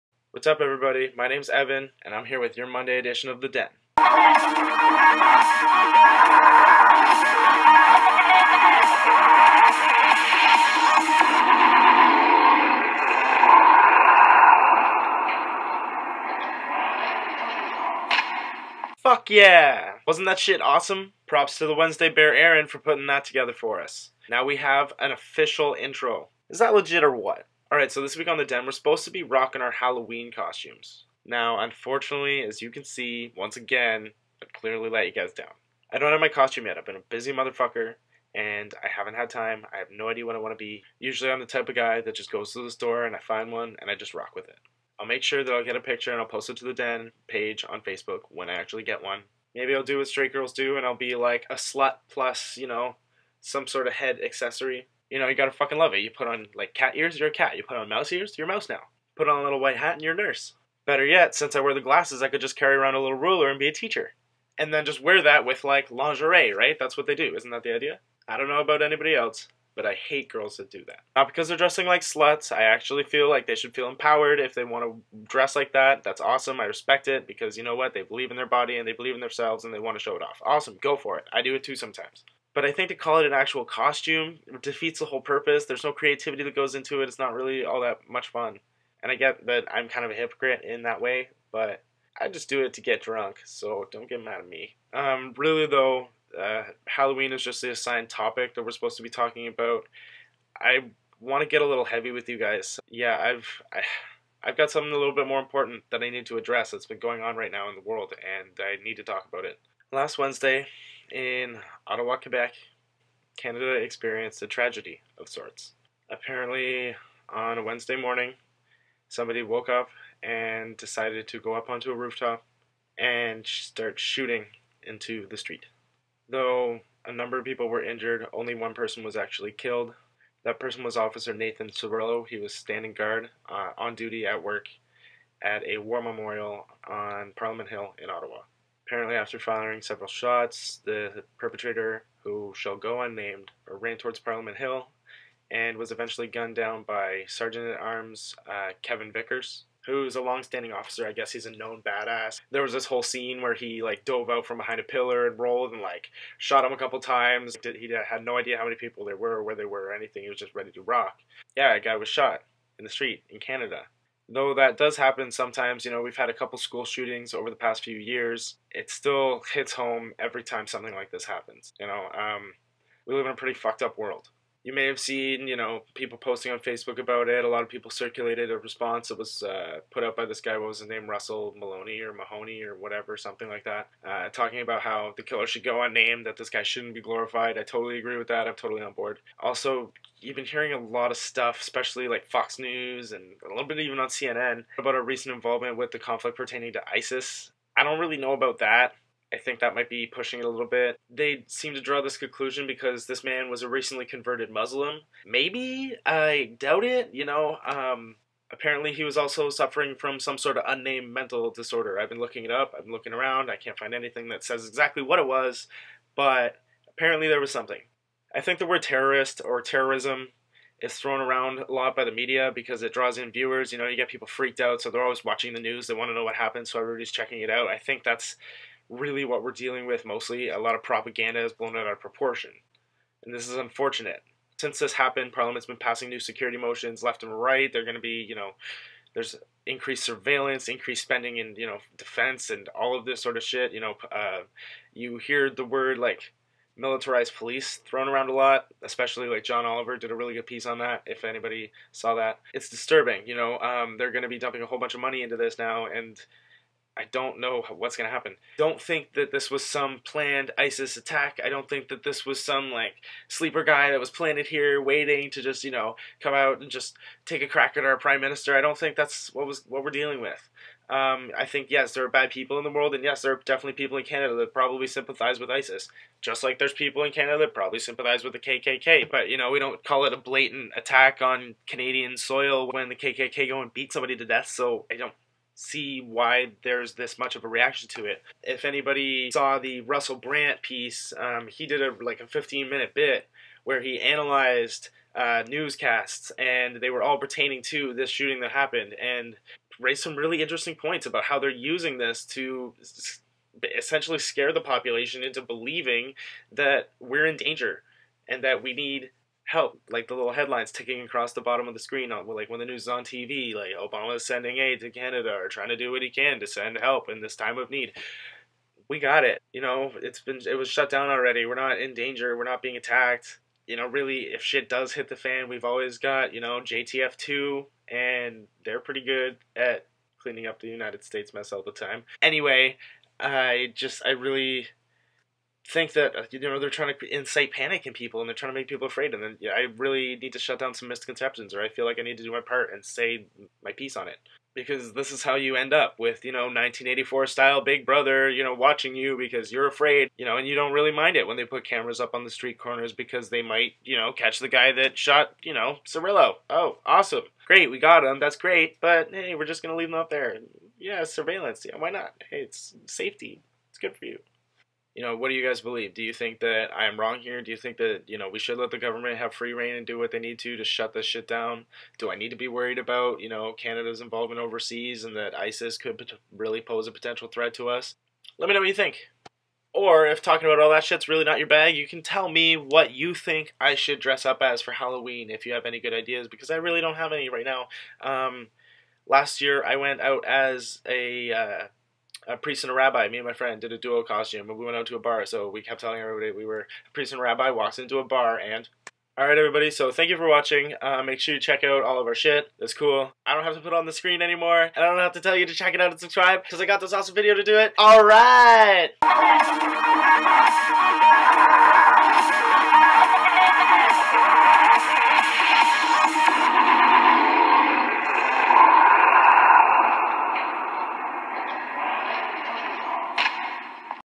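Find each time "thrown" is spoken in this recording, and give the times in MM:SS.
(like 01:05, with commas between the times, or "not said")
03:40, 04:07.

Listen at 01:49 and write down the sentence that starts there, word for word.
Last Wednesday, in Ottawa, Quebec, Canada experienced a tragedy of sorts.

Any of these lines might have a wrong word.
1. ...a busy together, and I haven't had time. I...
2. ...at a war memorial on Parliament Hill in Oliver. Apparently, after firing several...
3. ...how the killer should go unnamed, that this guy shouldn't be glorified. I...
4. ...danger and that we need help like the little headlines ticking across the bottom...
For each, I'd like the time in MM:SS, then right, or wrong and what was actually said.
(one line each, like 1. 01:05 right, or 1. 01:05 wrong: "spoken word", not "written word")
1. 00:36 wrong: "motherfucker", not "together"
2. 02:15 wrong: "Ottawa", not "Oliver"
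3. 03:04 right
4. 05:07 right.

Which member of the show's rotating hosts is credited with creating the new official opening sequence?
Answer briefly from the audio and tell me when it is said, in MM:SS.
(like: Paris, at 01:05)
Aaron, at 00:22.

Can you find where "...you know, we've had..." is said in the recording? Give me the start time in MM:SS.
02:45.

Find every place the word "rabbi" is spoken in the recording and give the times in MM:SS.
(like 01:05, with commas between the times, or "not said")
06:32, 06:37.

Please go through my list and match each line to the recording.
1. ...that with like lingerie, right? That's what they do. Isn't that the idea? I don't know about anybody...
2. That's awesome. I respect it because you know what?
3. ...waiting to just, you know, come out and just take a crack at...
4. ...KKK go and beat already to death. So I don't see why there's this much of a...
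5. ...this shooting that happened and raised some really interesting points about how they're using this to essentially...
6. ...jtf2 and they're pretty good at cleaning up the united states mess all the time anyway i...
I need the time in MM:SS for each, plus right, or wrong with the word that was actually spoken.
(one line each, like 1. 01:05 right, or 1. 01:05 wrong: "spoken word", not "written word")
1. 01:05 right
2. 01:16 right
3. 04:24 right
4. 04:42 wrong: "somebody", not "already"
5. 04:57 right
6. 05:26 right.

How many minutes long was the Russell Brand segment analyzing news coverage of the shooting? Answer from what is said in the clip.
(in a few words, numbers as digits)
15.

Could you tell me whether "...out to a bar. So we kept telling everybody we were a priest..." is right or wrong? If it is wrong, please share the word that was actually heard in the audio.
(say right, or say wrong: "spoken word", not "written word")
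right.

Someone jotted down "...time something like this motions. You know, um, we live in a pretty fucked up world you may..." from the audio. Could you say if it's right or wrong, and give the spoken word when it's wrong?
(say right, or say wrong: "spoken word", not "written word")
wrong: "happens", not "motions".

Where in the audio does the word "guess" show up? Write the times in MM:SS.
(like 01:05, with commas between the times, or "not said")
02:31.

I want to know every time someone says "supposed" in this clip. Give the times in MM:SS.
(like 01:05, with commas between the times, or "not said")
00:28, 01:38.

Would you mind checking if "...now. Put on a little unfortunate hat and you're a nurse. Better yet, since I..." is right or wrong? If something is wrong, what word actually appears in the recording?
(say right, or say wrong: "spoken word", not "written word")
wrong: "white", not "unfortunate".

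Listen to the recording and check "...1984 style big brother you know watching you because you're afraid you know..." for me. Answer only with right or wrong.
right.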